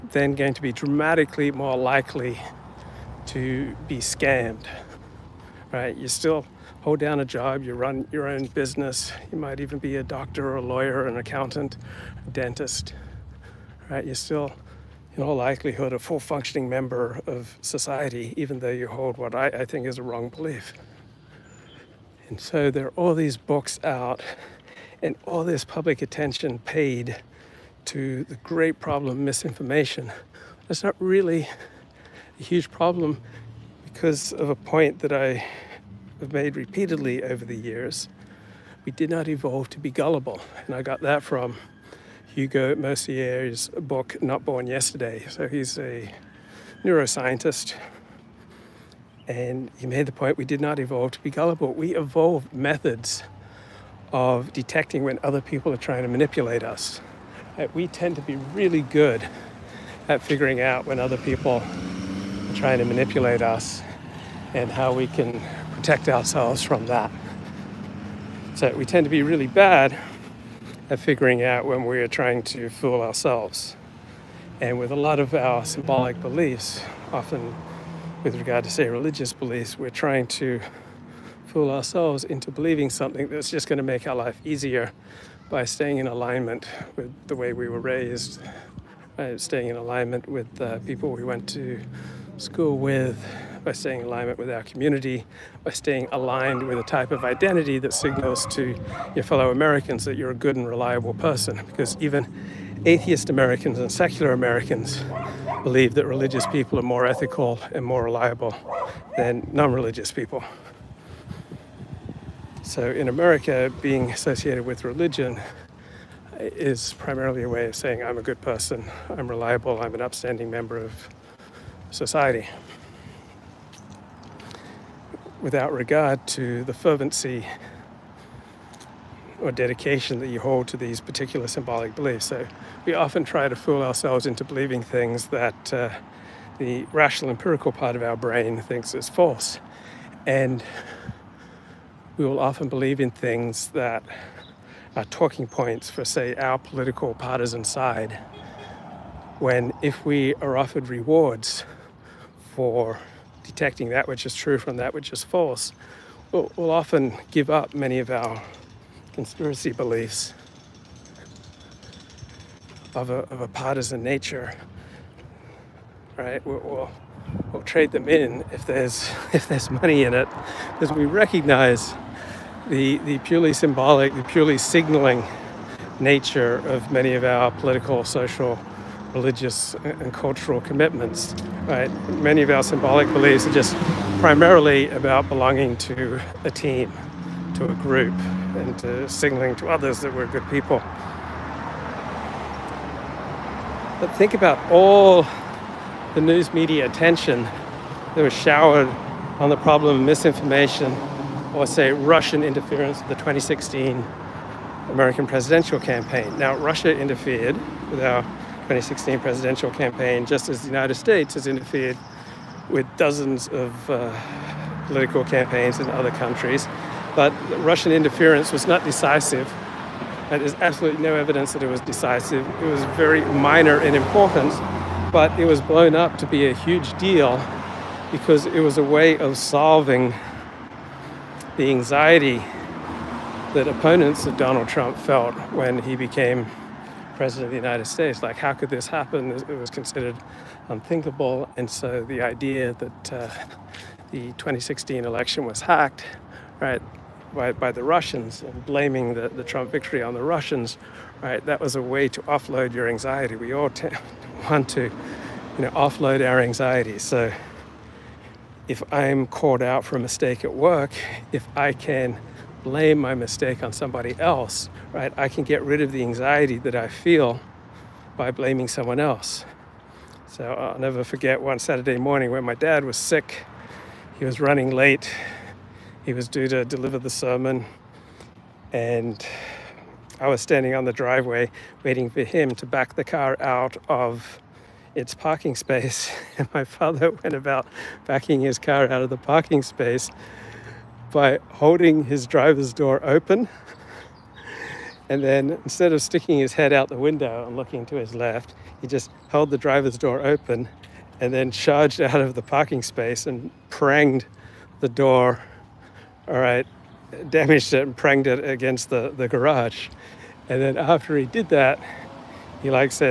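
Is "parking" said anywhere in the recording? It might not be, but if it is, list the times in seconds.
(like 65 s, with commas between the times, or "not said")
285 s, 289 s, 302 s.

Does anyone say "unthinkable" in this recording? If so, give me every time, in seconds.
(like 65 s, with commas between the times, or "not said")
240 s.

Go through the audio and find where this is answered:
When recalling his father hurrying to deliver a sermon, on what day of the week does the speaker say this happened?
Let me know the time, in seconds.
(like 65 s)
271 s.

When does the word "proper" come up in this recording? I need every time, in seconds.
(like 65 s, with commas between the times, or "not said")
not said.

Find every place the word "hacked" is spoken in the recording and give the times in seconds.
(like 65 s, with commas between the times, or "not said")
245 s.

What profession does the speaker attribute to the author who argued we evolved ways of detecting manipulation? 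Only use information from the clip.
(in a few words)
neuroscientist.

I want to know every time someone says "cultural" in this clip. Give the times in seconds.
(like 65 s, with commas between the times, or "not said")
180 s.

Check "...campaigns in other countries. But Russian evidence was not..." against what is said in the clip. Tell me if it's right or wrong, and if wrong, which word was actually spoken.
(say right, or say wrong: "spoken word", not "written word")
wrong: "interference", not "evidence".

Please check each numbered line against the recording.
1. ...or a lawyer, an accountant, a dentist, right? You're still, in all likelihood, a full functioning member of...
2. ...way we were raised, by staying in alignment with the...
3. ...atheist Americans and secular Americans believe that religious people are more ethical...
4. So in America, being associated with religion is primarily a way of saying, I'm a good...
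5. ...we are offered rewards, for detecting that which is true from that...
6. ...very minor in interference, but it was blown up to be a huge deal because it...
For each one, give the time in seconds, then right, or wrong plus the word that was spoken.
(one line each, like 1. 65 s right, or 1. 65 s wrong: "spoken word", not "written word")
1. 10 s right
2. 87 s right
3. 102 s right
4. 112 s right
5. 150 s right
6. 222 s wrong: "importance", not "interference".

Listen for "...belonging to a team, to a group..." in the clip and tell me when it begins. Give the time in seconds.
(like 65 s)
185 s.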